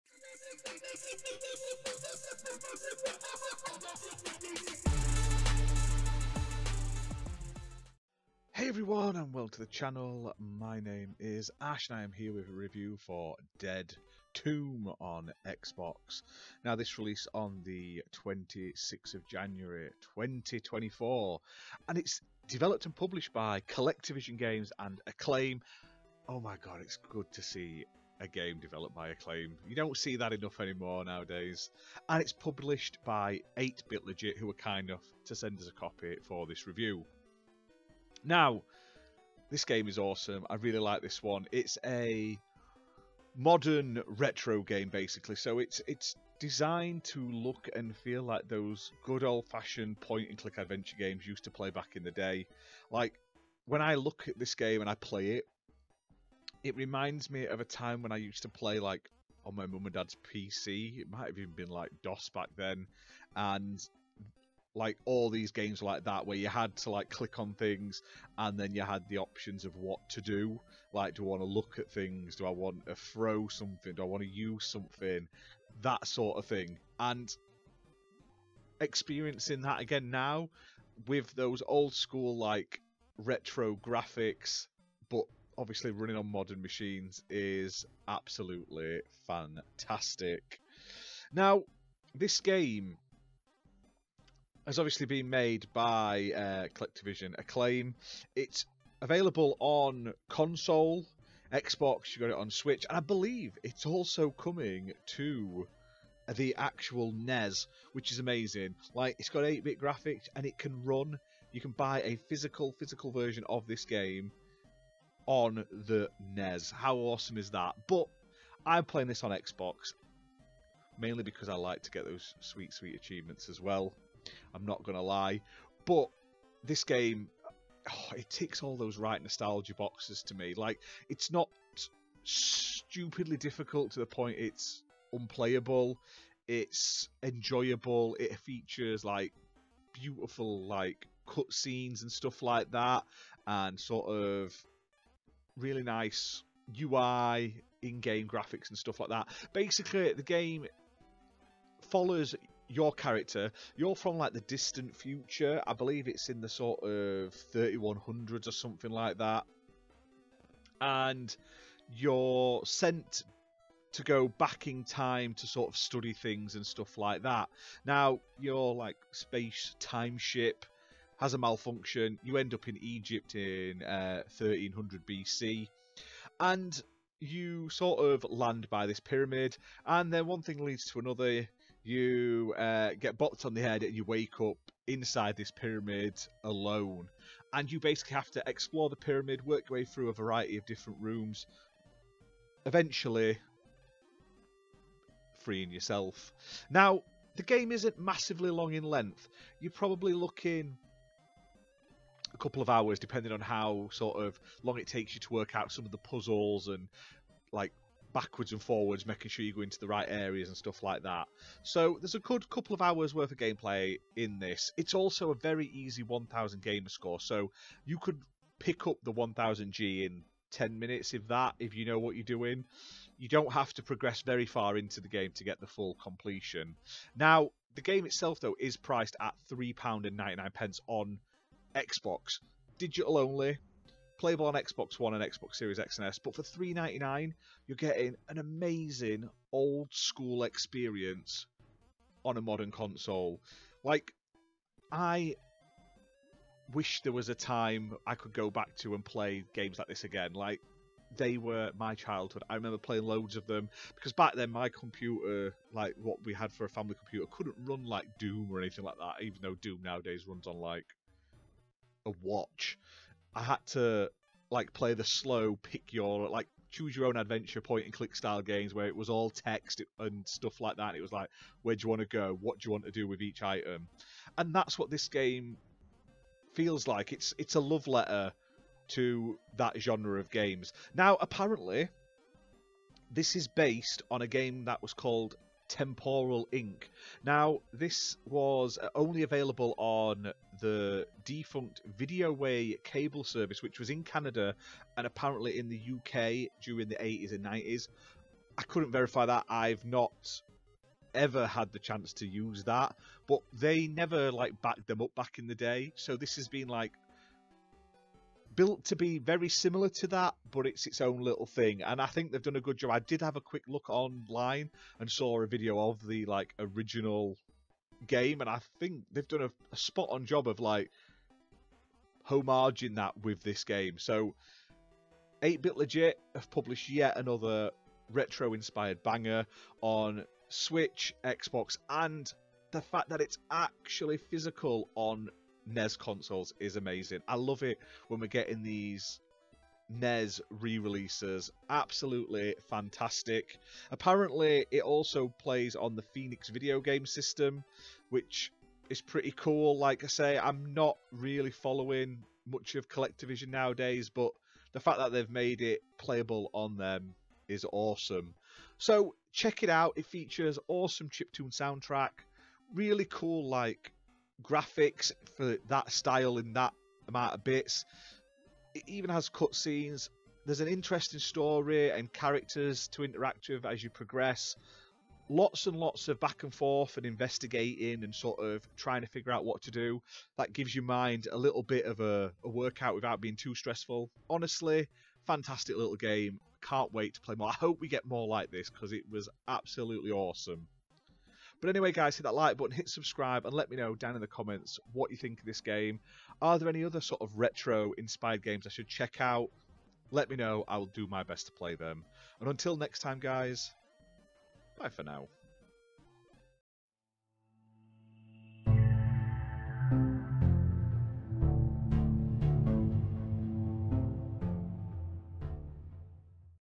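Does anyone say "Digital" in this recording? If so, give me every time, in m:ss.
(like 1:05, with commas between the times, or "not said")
3:52.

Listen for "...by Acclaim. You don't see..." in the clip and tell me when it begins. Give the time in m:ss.
0:28.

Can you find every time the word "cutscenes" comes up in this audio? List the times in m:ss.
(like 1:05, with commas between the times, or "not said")
2:21, 6:09.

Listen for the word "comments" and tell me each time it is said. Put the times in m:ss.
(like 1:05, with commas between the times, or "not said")
6:34.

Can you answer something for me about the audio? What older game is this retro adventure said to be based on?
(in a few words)
Temporal Inc.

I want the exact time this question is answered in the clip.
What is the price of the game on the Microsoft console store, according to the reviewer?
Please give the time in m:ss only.
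3:49.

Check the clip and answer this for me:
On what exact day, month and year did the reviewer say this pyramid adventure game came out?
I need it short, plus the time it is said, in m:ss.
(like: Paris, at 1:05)
26 January 2024, at 0:18.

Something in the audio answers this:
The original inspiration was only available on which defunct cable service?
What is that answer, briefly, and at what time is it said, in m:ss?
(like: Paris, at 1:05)
Videoway, at 4:51.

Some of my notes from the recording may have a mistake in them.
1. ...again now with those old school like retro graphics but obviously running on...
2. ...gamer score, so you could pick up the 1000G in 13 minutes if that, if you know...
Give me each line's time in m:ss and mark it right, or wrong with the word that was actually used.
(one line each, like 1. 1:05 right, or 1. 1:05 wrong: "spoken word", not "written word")
1. 1:19 right
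2. 3:36 wrong: "10", not "13".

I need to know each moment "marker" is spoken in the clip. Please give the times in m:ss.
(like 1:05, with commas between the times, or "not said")
not said.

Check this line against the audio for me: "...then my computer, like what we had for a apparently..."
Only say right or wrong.
wrong.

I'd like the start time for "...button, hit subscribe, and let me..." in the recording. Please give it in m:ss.
6:32.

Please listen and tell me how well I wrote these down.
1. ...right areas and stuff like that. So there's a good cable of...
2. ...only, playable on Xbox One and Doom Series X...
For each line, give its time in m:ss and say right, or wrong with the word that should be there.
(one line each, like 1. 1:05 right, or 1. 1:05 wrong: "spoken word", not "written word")
1. 3:29 wrong: "couple", not "cable"
2. 3:53 wrong: "Xbox", not "Doom".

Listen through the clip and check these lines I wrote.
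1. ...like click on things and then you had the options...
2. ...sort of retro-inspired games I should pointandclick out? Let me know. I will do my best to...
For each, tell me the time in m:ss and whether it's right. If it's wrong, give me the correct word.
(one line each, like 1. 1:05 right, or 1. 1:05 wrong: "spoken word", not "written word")
1. 1:06 right
2. 6:36 wrong: "check", not "pointandclick".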